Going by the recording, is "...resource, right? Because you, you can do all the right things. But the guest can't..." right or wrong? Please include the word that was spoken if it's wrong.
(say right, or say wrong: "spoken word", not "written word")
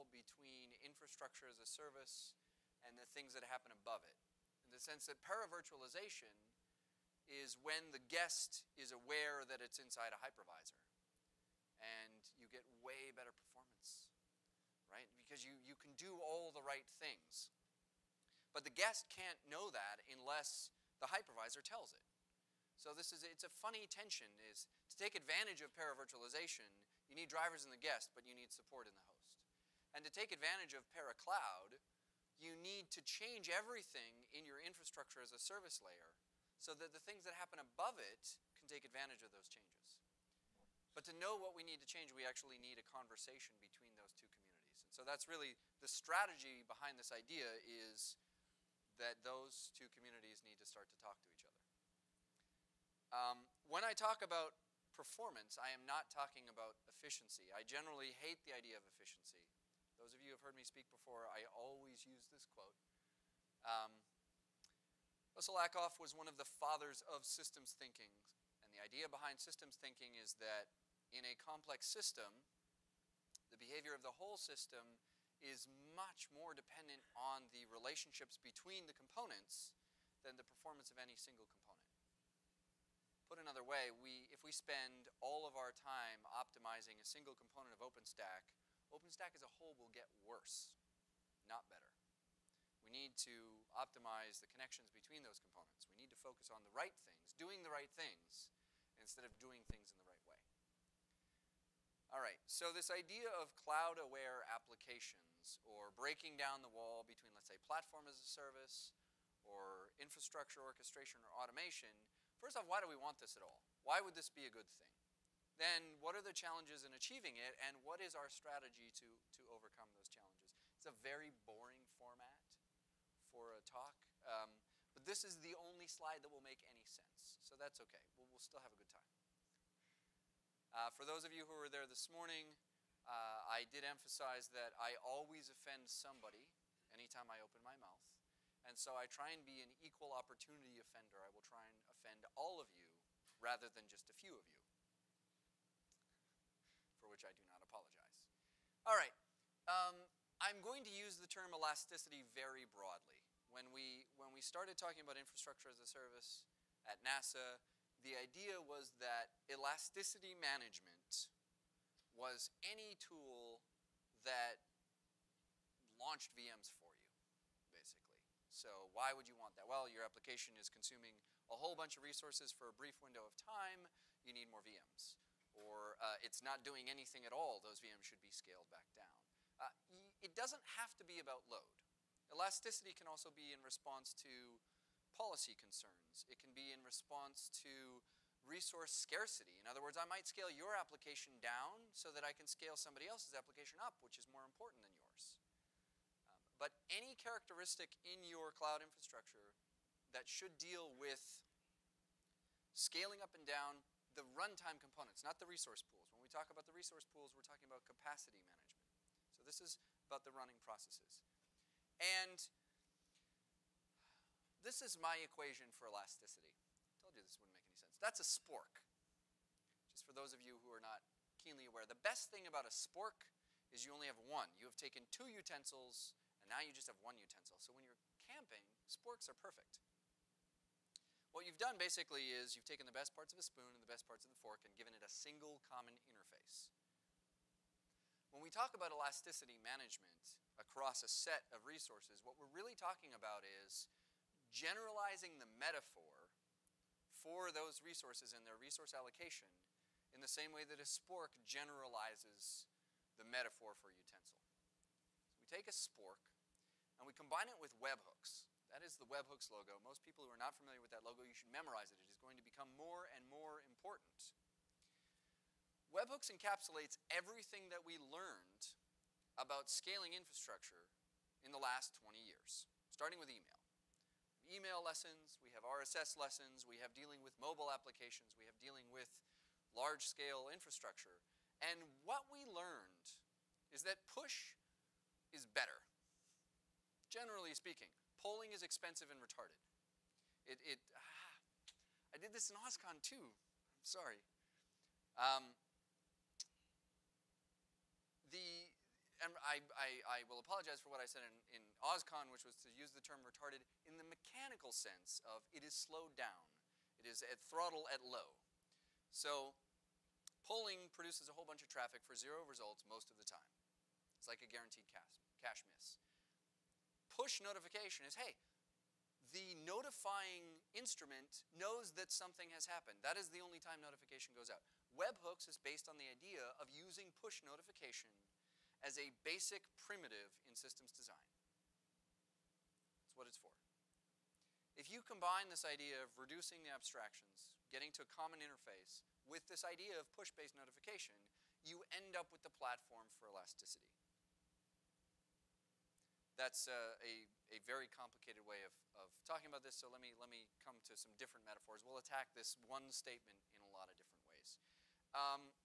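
wrong: "performance", not "resource".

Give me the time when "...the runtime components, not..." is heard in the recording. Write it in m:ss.
3:24.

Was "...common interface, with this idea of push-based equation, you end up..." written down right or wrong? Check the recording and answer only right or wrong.
wrong.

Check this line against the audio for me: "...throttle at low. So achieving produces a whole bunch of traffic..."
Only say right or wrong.
wrong.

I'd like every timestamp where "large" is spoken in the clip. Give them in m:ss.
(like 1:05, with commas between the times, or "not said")
4:39.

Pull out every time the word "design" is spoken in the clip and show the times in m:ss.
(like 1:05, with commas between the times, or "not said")
5:30.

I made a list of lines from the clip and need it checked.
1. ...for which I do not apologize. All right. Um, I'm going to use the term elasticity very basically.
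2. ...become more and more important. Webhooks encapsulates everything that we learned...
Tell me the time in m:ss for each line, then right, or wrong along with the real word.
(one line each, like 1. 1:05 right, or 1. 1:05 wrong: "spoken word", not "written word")
1. 2:26 wrong: "broadly", not "basically"
2. 4:22 right.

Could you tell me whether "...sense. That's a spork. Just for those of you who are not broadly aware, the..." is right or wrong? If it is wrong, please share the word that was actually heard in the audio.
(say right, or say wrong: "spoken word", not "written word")
wrong: "keenly", not "broadly".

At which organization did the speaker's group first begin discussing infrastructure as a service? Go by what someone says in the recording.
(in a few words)
NASA.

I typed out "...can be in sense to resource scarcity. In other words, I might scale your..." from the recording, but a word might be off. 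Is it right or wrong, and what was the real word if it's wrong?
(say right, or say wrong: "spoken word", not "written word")
wrong: "response", not "sense".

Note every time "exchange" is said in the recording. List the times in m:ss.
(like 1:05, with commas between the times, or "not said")
not said.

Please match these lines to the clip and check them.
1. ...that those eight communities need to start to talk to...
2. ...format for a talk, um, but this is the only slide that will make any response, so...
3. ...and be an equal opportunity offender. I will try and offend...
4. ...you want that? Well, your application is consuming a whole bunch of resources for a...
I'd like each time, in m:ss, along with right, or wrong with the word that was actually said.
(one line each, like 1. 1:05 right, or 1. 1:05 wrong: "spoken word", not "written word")
1. 0:49 wrong: "two", not "eight"
2. 2:01 wrong: "sense", not "response"
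3. 2:19 right
4. 2:49 right.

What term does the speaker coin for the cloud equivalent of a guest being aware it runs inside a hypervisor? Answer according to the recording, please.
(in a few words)
paracloud.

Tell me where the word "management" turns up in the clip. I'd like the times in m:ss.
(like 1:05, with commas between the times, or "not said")
2:40, 3:28, 3:59.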